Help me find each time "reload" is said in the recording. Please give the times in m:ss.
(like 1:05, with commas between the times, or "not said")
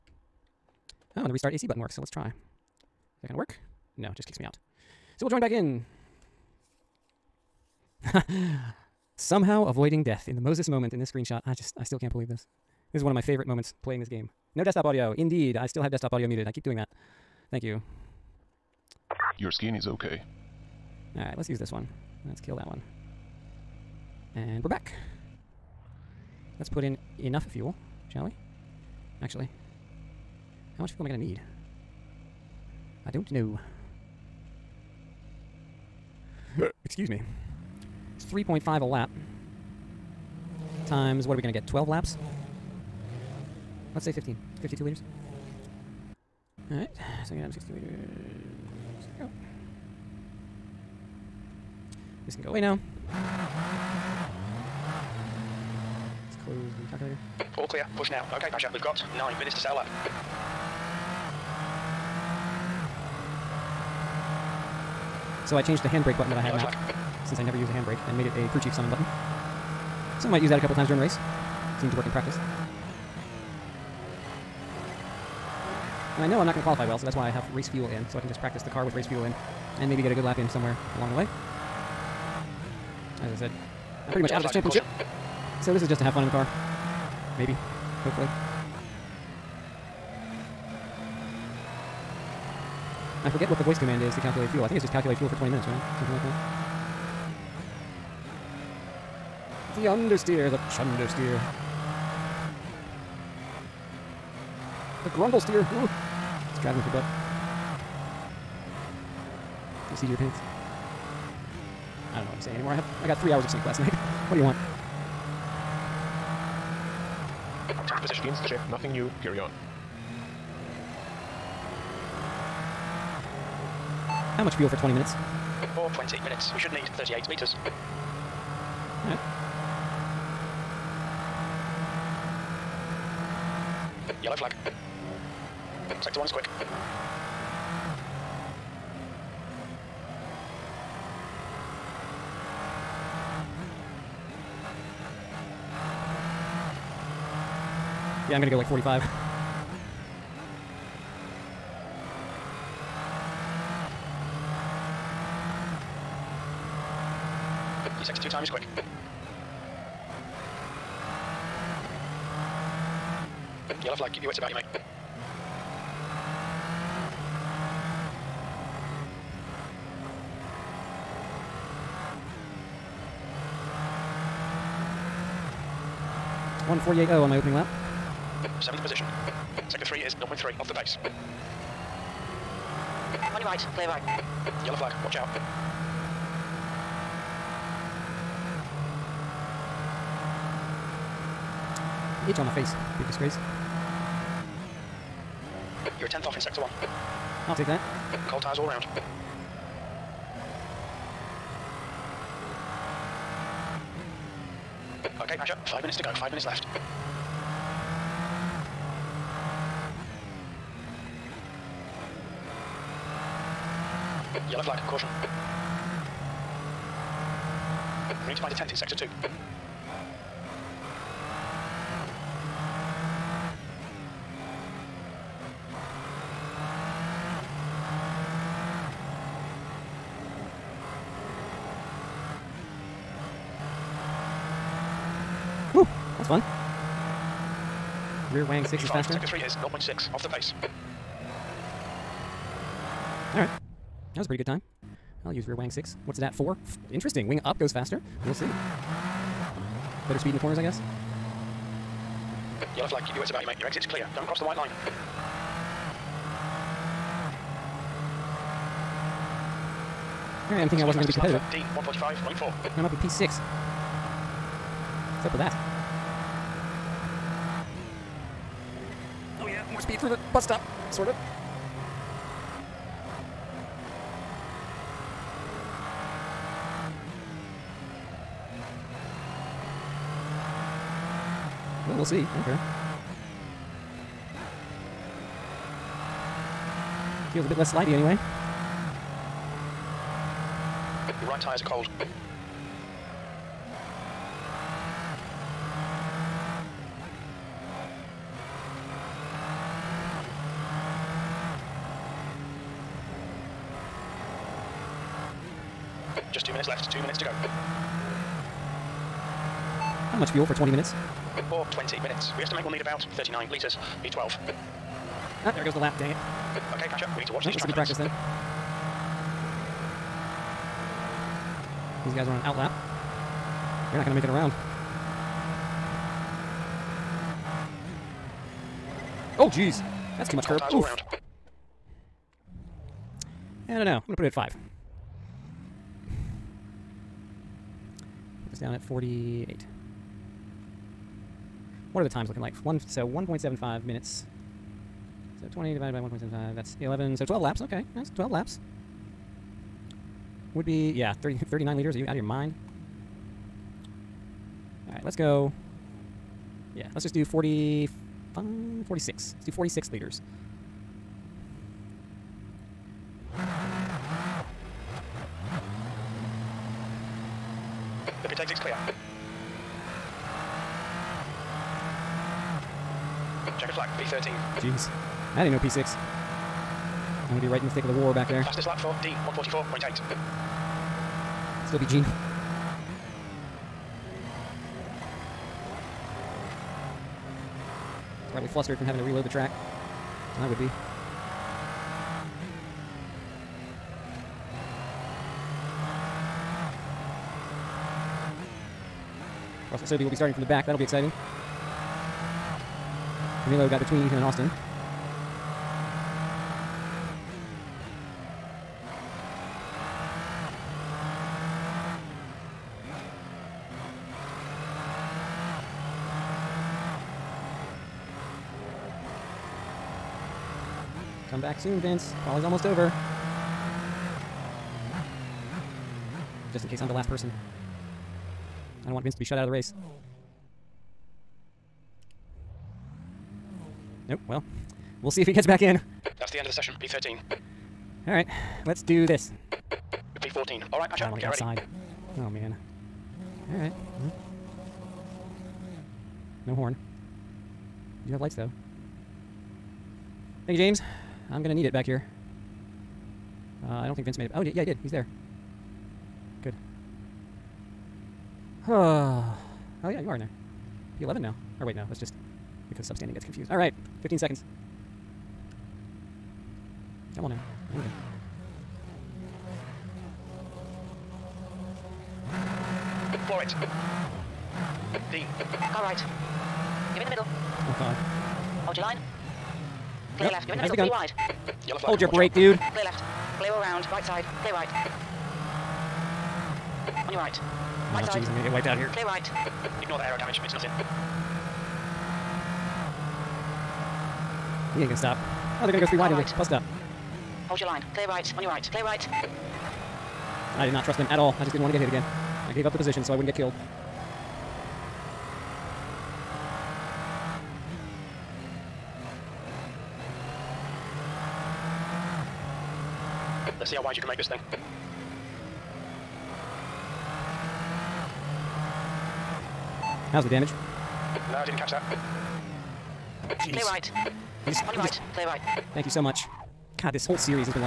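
6:29.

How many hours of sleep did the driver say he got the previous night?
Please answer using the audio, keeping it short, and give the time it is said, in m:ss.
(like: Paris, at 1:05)
3, at 1:53.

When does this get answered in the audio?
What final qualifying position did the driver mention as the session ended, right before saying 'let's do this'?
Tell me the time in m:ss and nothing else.
7:16.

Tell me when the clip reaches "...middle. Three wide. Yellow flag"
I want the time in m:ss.
8:00.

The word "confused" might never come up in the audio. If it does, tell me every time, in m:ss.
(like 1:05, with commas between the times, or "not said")
7:43.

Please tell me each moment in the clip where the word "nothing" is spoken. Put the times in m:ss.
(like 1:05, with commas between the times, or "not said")
1:58, 8:10.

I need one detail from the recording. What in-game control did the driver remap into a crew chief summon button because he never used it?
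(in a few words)
handbrake button.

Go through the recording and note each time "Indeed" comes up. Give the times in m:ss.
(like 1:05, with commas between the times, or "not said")
0:15.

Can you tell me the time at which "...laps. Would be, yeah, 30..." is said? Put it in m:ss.
5:48.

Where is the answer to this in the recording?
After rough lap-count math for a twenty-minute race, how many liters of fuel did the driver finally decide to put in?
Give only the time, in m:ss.
5:59.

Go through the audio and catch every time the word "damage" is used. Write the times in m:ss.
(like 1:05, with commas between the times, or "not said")
8:10, 8:40.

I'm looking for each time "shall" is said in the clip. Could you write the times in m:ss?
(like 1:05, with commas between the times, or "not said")
0:28.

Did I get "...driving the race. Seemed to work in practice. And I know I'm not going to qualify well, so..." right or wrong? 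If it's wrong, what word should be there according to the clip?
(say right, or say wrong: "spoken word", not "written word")
wrong: "during", not "driving".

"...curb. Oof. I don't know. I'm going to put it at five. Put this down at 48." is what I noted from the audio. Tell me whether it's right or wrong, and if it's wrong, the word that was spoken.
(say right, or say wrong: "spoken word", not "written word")
right.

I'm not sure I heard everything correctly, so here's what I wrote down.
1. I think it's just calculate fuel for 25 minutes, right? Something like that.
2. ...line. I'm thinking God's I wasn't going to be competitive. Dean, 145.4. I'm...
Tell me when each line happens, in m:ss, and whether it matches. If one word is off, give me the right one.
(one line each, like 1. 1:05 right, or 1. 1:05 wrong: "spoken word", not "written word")
1. 1:34 wrong: "20", not "25"
2. 4:14 wrong: "That", not "God".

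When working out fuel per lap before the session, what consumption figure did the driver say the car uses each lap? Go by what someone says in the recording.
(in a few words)
3.5.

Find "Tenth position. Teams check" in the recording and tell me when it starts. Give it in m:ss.
1:57.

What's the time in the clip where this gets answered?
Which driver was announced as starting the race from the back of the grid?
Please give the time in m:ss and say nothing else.
6:39.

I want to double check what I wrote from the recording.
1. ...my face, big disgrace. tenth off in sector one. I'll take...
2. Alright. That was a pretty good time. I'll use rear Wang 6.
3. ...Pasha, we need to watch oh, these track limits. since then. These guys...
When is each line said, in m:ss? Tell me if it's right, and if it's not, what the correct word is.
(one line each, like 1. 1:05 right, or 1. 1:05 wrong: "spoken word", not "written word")
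1. 3:12 right
2. 4:03 right
3. 5:16 wrong: "practice", not "since".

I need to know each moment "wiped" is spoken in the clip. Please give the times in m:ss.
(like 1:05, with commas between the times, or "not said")
8:08.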